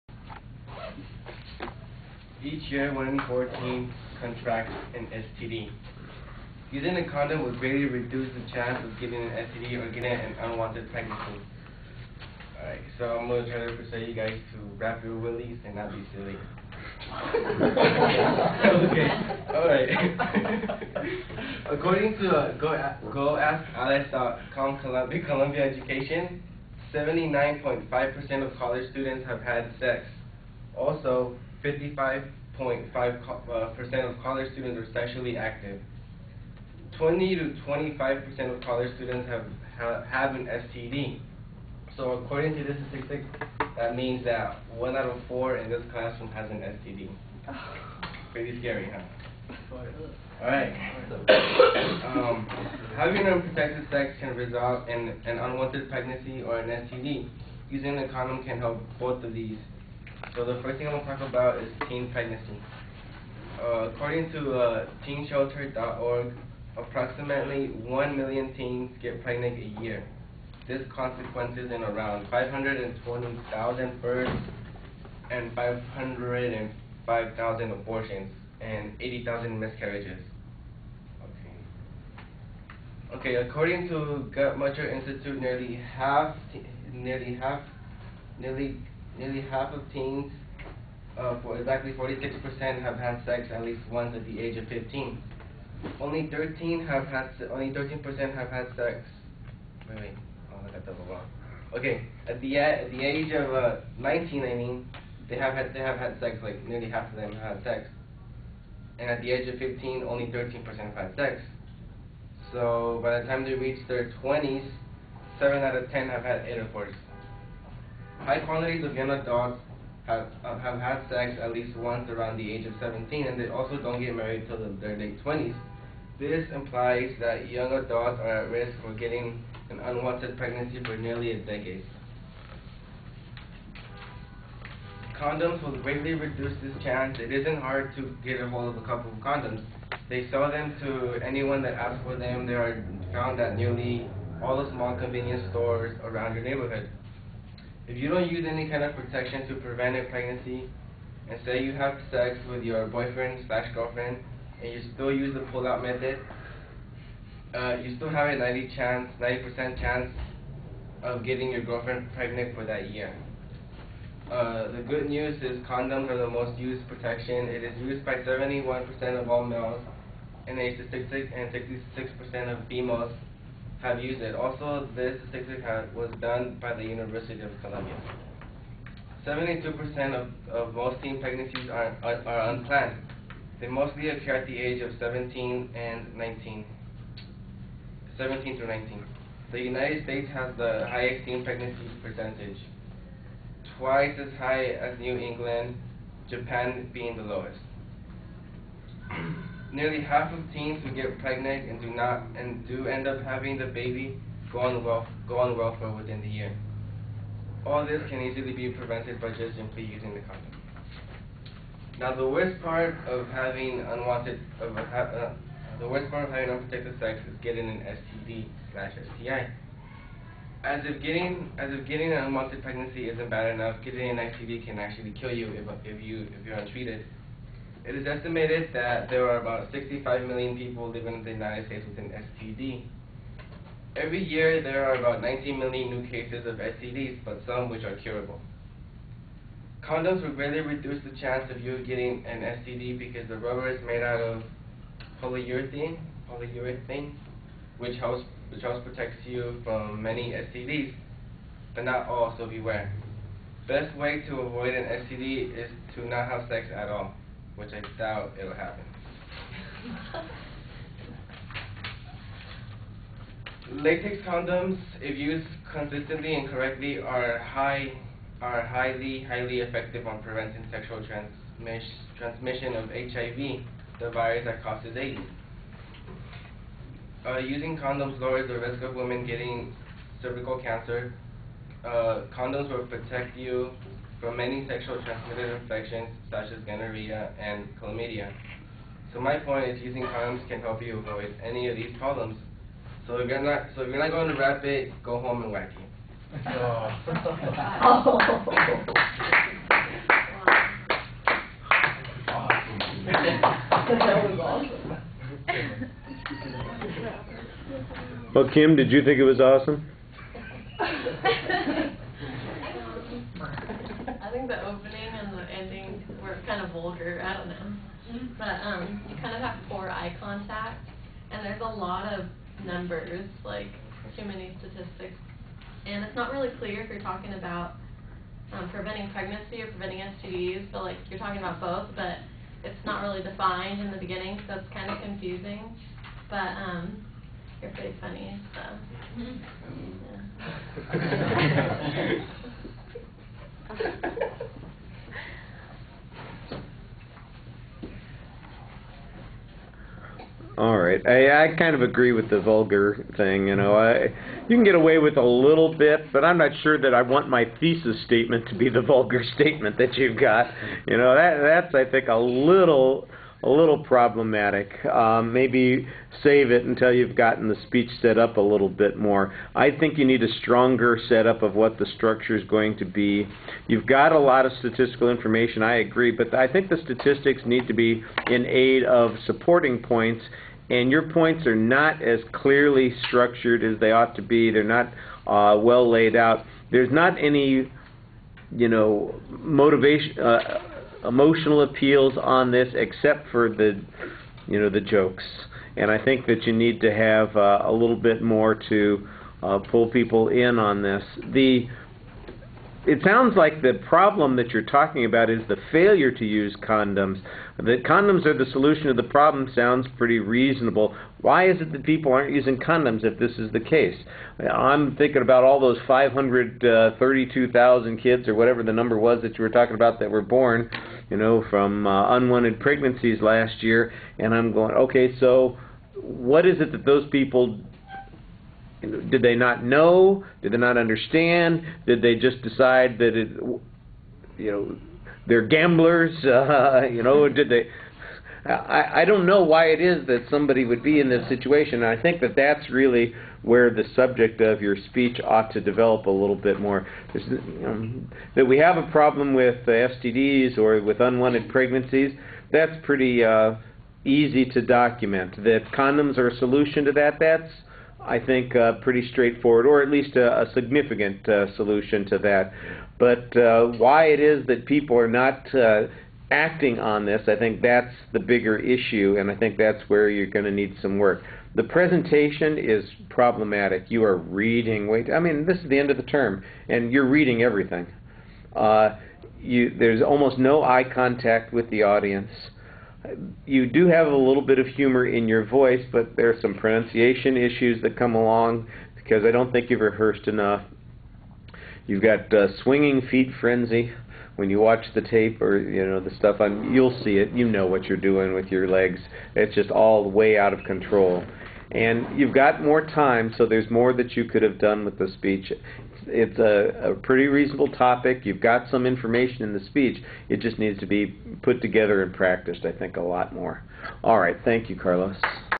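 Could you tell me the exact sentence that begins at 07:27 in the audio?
There's, um, that we have a problem with uh, STDs or with unwanted pregnancies, that's pretty uh, easy to document.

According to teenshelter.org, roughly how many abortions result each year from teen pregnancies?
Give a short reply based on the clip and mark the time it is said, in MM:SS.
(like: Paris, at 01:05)
505,000, at 01:15.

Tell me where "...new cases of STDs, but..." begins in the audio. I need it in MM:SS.
03:55.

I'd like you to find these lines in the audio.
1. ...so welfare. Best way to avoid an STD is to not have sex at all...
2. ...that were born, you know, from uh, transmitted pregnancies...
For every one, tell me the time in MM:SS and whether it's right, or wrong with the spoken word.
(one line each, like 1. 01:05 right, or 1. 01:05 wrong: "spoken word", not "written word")
1. 04:12 wrong: "beware", not "welfare"
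2. 06:59 wrong: "unwanted", not "transmitted".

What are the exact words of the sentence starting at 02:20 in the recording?
They sell them to anyone that asks for them.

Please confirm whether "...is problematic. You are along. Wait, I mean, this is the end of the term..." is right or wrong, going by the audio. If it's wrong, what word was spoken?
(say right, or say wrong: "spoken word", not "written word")
wrong: "reading", not "along".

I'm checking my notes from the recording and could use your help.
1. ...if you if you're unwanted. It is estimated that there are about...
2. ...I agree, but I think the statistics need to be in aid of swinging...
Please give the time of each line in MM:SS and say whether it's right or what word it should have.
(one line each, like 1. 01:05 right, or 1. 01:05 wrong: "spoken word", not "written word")
1. 03:45 wrong: "untreated", not "unwanted"
2. 06:15 wrong: "supporting", not "swinging".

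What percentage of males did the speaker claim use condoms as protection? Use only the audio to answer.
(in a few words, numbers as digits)
71%.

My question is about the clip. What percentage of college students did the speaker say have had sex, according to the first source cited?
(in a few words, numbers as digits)
79.5%.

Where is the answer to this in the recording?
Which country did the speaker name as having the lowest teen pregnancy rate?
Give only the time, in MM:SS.
03:16.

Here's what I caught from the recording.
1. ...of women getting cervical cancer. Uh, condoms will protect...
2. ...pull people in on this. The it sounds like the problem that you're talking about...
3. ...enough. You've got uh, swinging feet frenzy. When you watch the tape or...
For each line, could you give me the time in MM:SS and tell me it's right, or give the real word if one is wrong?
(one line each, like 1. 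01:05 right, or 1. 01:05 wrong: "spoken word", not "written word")
1. 04:38 right
2. 06:39 right
3. 08:10 right.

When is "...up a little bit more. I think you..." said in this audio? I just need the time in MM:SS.
06:08.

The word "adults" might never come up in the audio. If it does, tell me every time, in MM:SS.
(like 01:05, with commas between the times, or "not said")
01:59, 02:07.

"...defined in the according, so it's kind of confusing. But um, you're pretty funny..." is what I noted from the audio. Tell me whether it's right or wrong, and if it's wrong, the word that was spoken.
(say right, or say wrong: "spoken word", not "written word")
wrong: "beginning", not "according".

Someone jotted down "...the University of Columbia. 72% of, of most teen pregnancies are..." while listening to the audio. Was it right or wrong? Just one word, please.
right.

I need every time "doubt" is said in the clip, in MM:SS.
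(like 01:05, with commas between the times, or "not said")
04:17.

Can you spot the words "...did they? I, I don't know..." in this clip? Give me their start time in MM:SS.
07:17.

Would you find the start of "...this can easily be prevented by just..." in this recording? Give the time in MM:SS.
03:27.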